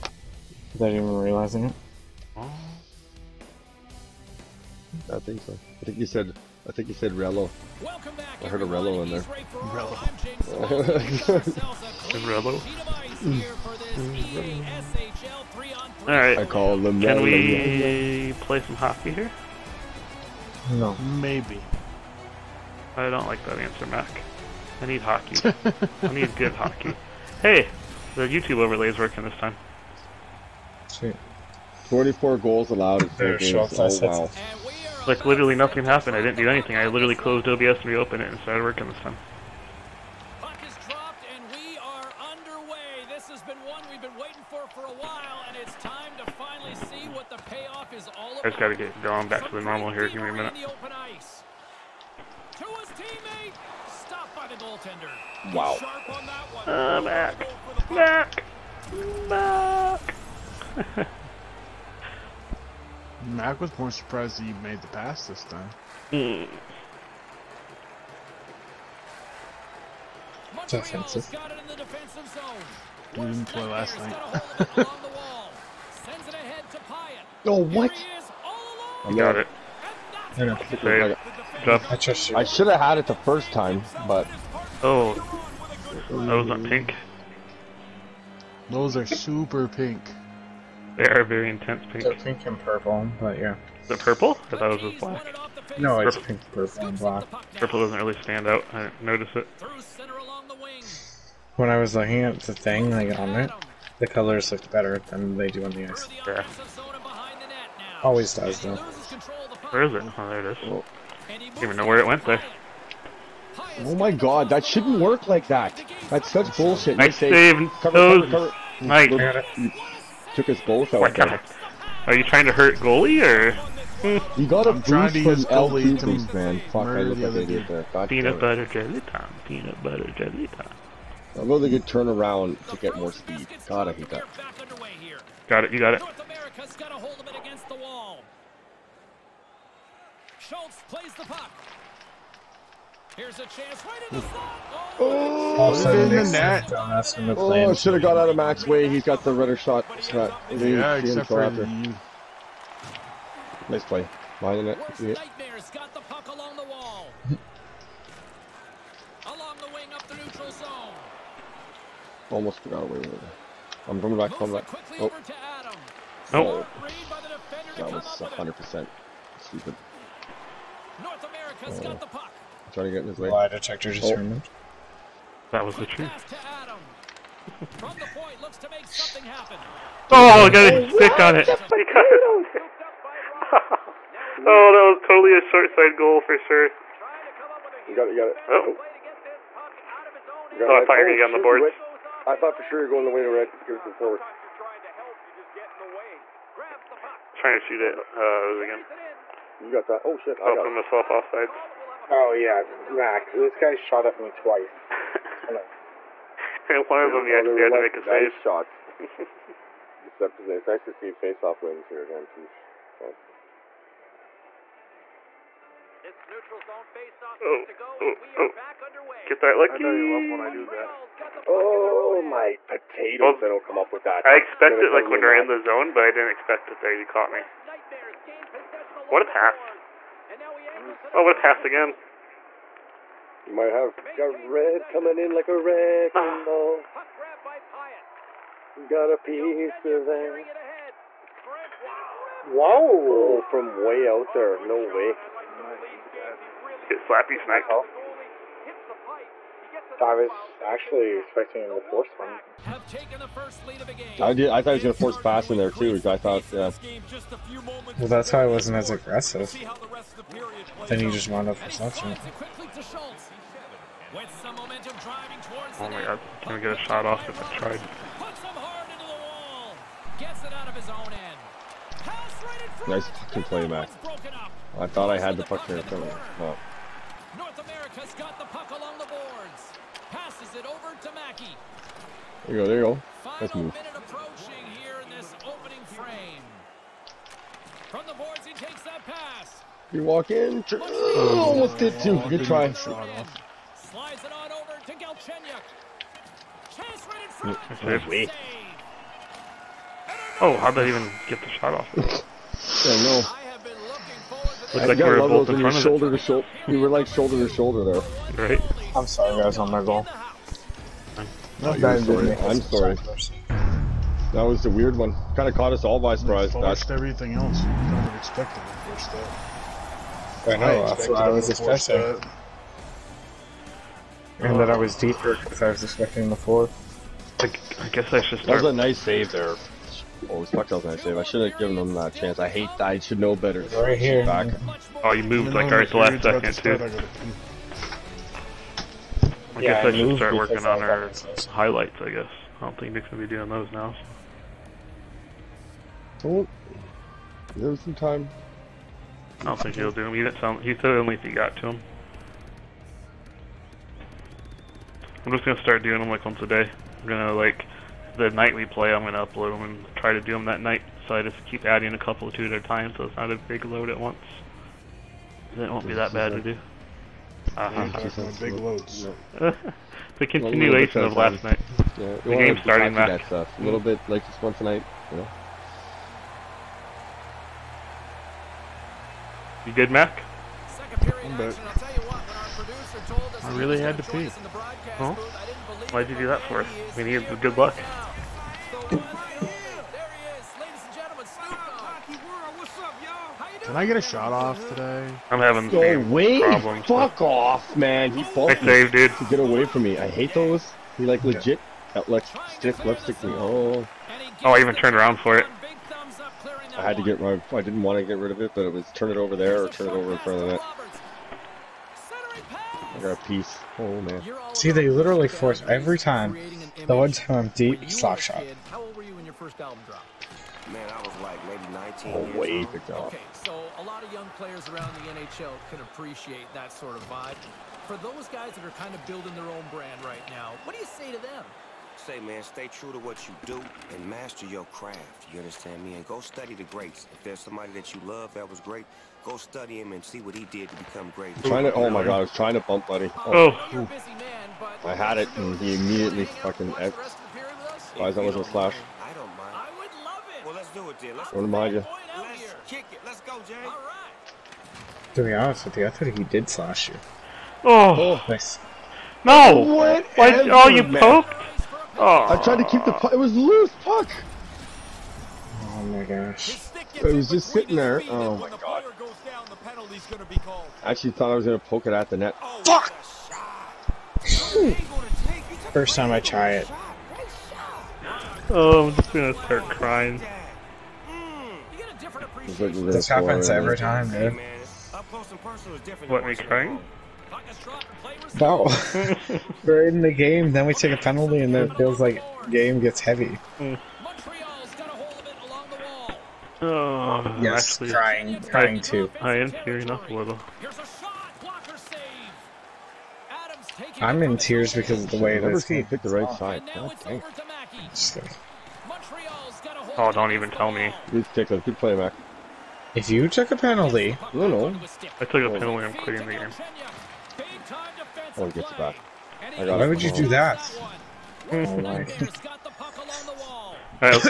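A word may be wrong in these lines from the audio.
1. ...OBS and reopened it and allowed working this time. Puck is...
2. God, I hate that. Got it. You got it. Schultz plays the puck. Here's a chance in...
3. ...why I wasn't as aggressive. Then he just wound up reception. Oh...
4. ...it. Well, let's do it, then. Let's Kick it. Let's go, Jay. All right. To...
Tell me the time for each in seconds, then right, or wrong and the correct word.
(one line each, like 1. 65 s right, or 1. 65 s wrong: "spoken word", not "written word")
1. 37 s wrong: "started", not "allowed"
2. 133 s right
3. 258 s right
4. 450 s right.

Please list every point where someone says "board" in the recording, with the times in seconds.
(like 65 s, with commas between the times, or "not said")
191 s, 288 s.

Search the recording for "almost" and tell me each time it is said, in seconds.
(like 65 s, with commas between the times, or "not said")
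162 s, 291 s.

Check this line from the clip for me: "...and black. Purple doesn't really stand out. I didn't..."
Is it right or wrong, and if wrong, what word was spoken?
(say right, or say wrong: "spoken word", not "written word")
right.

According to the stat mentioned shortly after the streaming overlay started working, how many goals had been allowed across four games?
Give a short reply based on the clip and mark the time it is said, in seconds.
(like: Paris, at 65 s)
24, at 31 s.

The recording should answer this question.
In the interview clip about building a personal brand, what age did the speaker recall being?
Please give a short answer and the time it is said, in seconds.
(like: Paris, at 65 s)
19, at 421 s.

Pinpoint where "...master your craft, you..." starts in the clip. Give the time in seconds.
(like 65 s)
434 s.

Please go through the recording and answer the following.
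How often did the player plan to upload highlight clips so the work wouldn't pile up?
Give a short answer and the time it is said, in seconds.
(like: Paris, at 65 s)
Once a day, at 356 s.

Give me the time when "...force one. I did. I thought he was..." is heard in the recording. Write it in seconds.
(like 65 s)
251 s.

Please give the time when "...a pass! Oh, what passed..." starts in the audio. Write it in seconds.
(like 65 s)
229 s.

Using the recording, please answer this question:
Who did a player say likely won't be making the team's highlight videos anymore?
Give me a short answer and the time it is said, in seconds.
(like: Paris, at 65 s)
Nick, at 342 s.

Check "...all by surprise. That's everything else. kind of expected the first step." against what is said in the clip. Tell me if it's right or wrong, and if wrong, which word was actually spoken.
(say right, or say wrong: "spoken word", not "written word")
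right.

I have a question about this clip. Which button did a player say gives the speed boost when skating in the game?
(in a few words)
L2.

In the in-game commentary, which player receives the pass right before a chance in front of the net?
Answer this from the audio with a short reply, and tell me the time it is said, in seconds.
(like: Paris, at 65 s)
Galchenyuk, at 294 s.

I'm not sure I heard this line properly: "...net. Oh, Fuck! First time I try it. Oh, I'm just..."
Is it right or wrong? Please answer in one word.
right.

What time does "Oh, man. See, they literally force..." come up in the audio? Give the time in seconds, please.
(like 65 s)
413 s.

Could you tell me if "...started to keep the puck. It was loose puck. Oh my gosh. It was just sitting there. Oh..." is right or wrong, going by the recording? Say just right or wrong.
wrong.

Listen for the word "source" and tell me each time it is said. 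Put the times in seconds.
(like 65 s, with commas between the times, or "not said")
not said.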